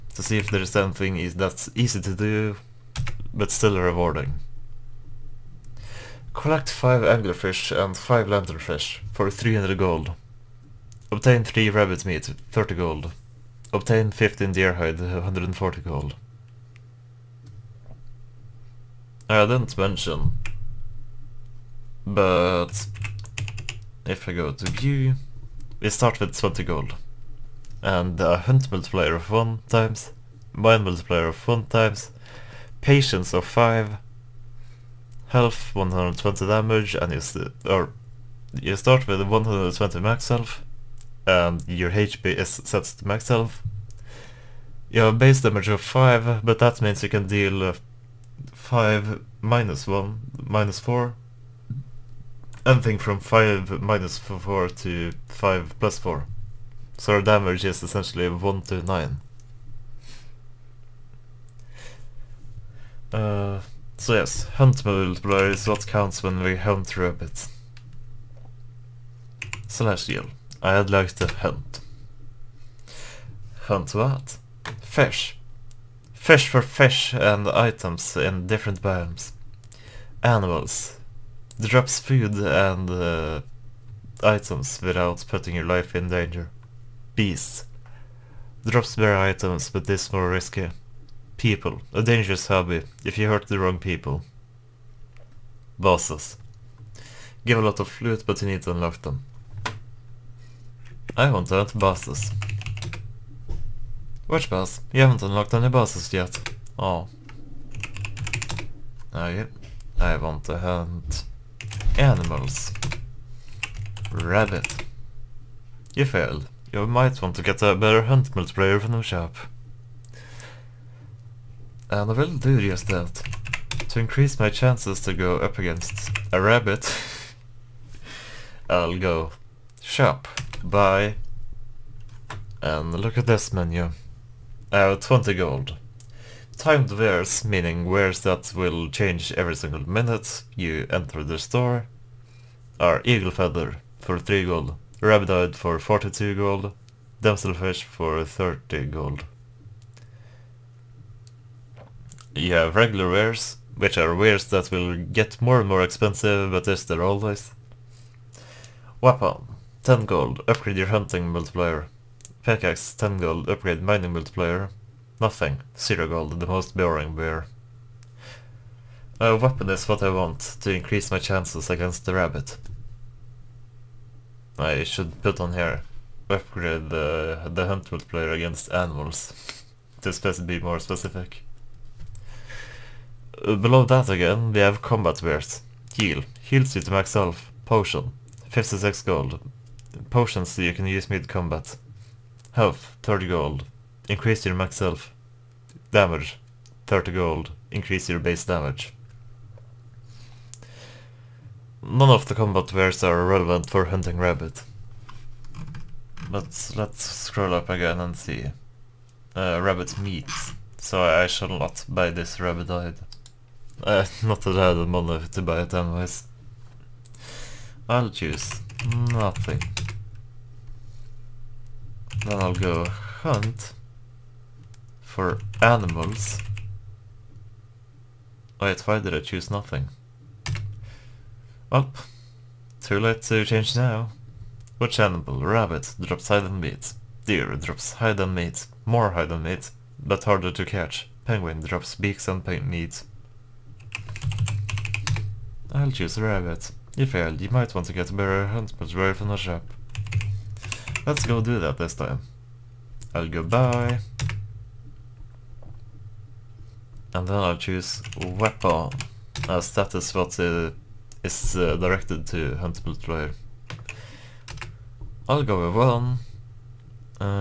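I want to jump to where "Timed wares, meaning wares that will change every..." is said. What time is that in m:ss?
2:16.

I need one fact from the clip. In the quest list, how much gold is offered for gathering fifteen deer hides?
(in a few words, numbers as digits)
140 gold.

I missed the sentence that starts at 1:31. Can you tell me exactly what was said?
A dangerous hobby if you hurt the wrong people.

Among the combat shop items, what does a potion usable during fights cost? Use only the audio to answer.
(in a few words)
56 gold.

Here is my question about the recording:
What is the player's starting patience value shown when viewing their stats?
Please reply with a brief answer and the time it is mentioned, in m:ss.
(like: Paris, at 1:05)
5, at 0:32.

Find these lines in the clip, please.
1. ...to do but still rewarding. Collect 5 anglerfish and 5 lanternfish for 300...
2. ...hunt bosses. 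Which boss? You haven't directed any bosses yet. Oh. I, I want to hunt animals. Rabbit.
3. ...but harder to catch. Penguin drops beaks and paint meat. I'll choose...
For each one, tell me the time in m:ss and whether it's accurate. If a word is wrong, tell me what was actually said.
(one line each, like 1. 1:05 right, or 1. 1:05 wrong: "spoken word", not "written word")
1. 0:02 right
2. 1:41 wrong: "unlocked", not "directed"
3. 4:00 right.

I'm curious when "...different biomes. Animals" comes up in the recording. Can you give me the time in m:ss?
1:18.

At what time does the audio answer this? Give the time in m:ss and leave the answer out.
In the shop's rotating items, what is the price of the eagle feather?
2:24.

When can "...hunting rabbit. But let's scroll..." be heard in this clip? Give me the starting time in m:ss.
3:23.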